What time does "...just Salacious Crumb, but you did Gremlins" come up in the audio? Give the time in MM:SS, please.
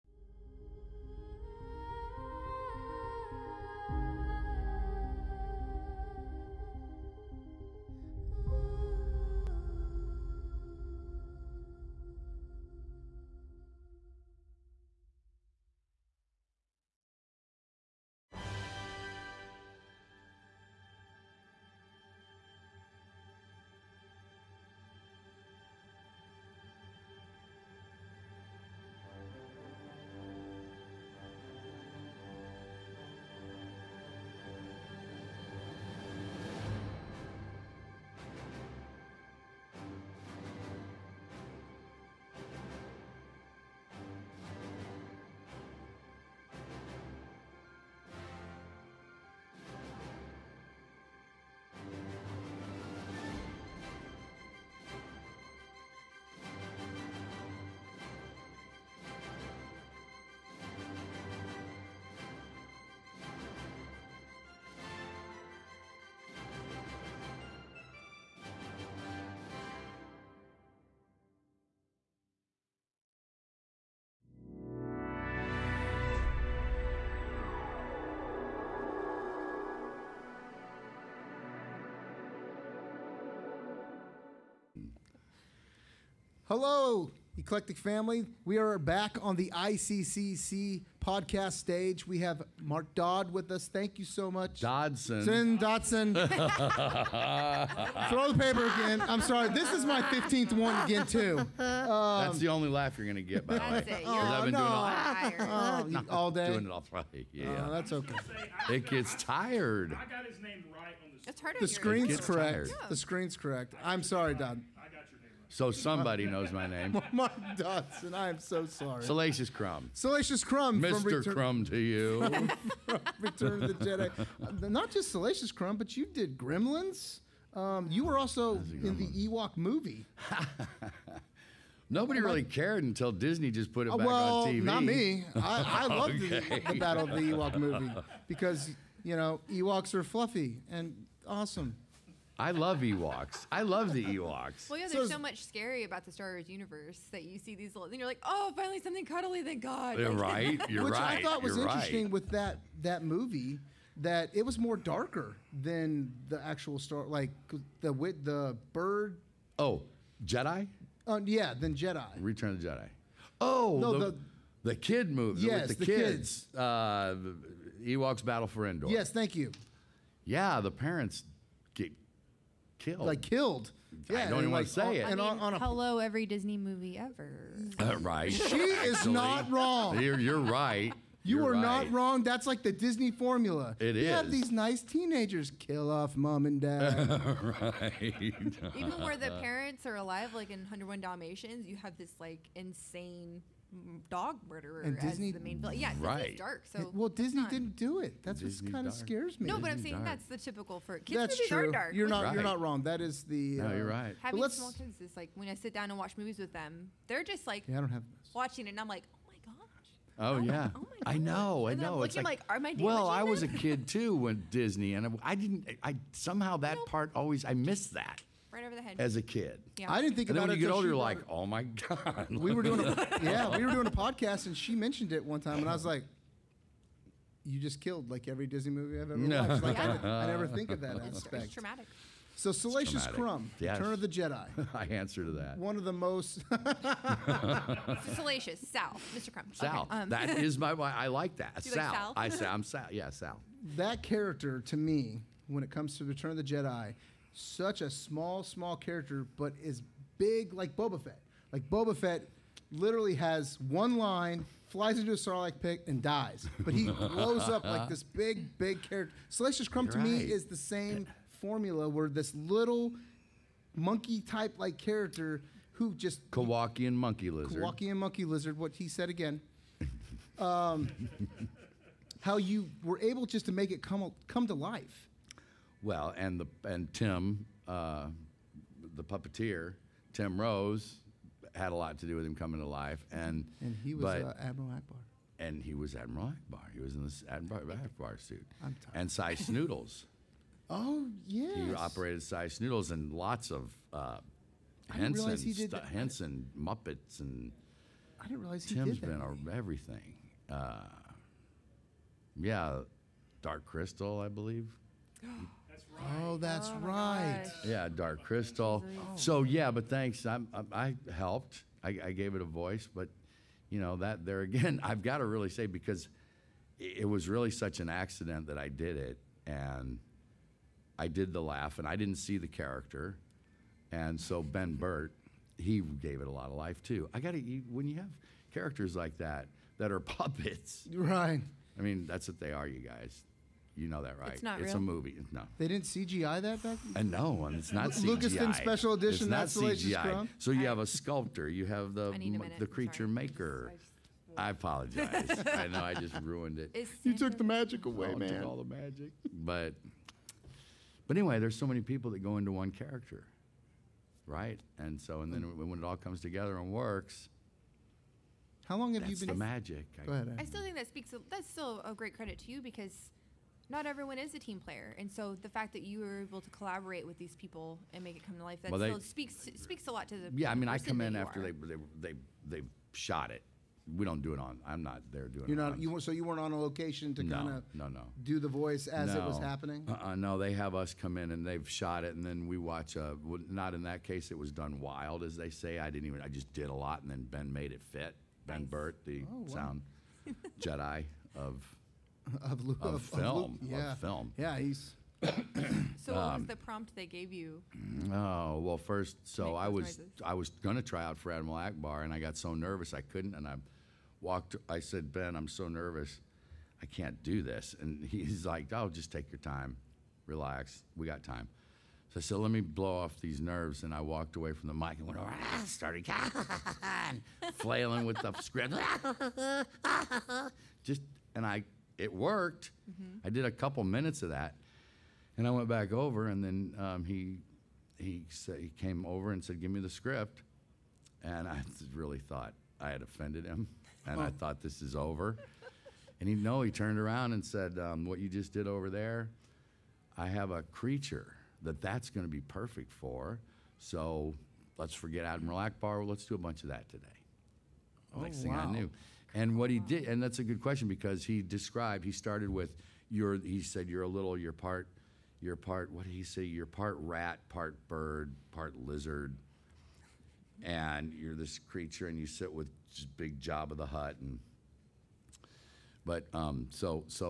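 02:04.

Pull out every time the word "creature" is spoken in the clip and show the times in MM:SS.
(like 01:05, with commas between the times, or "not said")
05:42, 07:20, 07:41.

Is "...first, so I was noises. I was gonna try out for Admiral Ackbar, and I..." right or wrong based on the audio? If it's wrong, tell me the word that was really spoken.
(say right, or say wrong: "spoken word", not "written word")
right.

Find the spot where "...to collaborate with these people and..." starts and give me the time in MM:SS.
06:06.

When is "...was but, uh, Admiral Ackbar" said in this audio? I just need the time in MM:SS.
04:43.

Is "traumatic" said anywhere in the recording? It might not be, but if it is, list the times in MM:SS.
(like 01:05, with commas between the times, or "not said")
03:51.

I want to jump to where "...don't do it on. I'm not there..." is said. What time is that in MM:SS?
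06:14.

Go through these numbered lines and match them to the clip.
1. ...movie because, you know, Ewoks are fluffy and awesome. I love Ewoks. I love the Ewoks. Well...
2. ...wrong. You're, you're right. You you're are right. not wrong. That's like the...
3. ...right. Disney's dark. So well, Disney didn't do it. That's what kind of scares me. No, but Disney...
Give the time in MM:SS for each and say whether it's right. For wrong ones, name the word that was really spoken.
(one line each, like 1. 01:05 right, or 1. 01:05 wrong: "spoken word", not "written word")
1. 02:17 right
2. 02:59 right
3. 03:15 right.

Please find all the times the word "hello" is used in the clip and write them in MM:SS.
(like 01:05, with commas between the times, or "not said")
01:26, 02:55.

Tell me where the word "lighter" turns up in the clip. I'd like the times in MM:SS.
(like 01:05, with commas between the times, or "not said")
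not said.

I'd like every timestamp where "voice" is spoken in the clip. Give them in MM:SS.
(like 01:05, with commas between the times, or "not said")
05:12, 06:18.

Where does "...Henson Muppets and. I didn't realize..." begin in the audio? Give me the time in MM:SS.
04:55.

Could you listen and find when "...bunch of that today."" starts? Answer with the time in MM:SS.
07:26.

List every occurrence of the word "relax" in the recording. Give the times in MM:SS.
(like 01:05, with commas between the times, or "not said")
06:50.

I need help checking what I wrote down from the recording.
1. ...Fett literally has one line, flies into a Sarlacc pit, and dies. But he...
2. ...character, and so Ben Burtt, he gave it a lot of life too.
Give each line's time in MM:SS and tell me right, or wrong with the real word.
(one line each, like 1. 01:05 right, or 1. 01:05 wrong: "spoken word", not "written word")
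1. 04:11 right
2. 05:22 right.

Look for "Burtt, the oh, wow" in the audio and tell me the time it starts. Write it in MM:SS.
06:28.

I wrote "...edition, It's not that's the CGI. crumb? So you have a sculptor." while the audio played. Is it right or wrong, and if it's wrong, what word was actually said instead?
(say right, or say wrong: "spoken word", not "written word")
right.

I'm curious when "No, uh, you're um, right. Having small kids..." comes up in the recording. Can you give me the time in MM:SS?
03:23.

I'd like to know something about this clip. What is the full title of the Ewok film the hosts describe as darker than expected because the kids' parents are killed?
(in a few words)
Ewoks: Battle for Endor.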